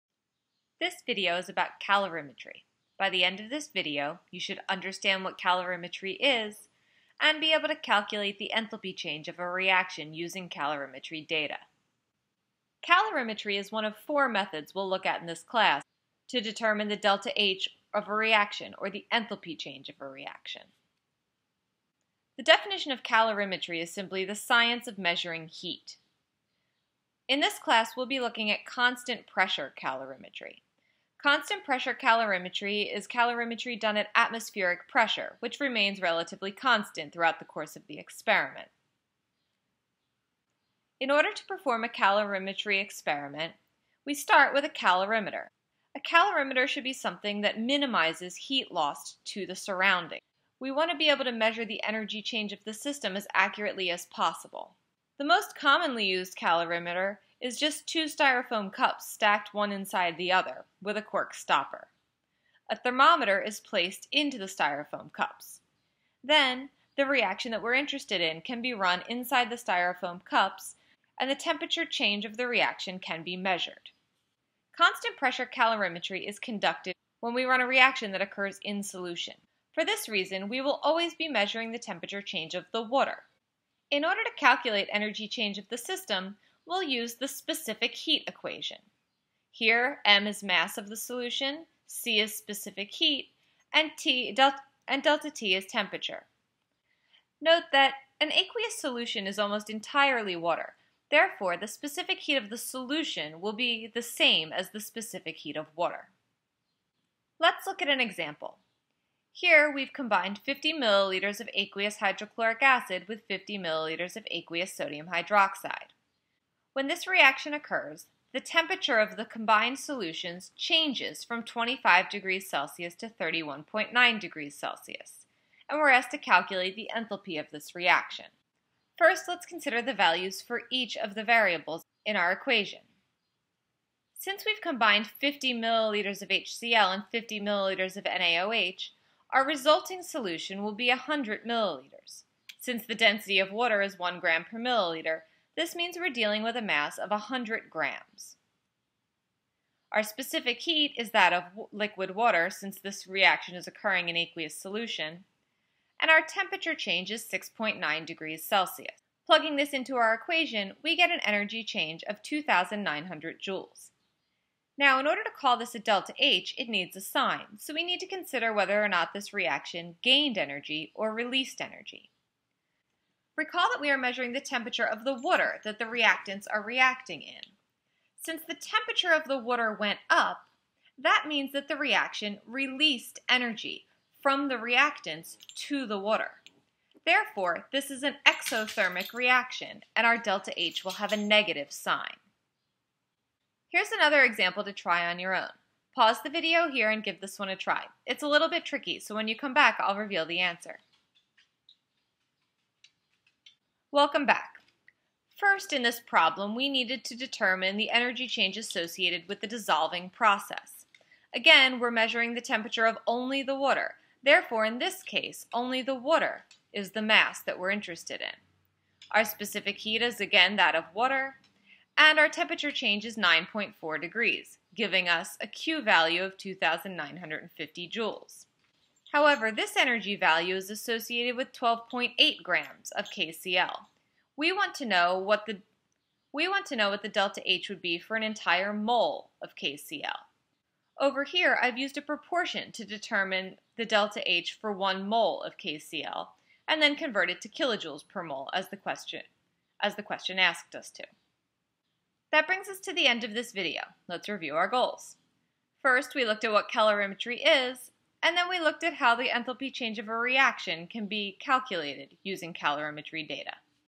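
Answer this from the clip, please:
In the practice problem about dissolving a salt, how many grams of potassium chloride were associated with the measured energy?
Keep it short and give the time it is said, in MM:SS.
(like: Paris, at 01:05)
12.8 grams, at 03:51.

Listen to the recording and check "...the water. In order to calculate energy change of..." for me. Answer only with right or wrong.
right.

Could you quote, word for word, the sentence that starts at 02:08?
First, let's consider the values for each of the variables in our equation.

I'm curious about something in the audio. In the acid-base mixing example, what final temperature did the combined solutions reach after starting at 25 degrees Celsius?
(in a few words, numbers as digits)
31.9 degrees Celsius.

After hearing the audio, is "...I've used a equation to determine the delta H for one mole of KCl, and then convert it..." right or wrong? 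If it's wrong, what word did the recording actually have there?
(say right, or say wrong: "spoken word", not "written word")
wrong: "proportion", not "equation".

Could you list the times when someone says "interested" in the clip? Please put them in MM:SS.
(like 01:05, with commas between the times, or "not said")
01:07, 03:37.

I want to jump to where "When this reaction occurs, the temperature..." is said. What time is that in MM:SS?
01:56.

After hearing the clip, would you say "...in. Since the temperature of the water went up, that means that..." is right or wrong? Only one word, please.
right.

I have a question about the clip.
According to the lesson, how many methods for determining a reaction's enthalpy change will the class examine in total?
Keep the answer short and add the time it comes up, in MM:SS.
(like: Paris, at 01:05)
4, at 00:14.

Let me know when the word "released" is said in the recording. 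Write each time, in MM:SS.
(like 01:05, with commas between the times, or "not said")
02:51, 03:02.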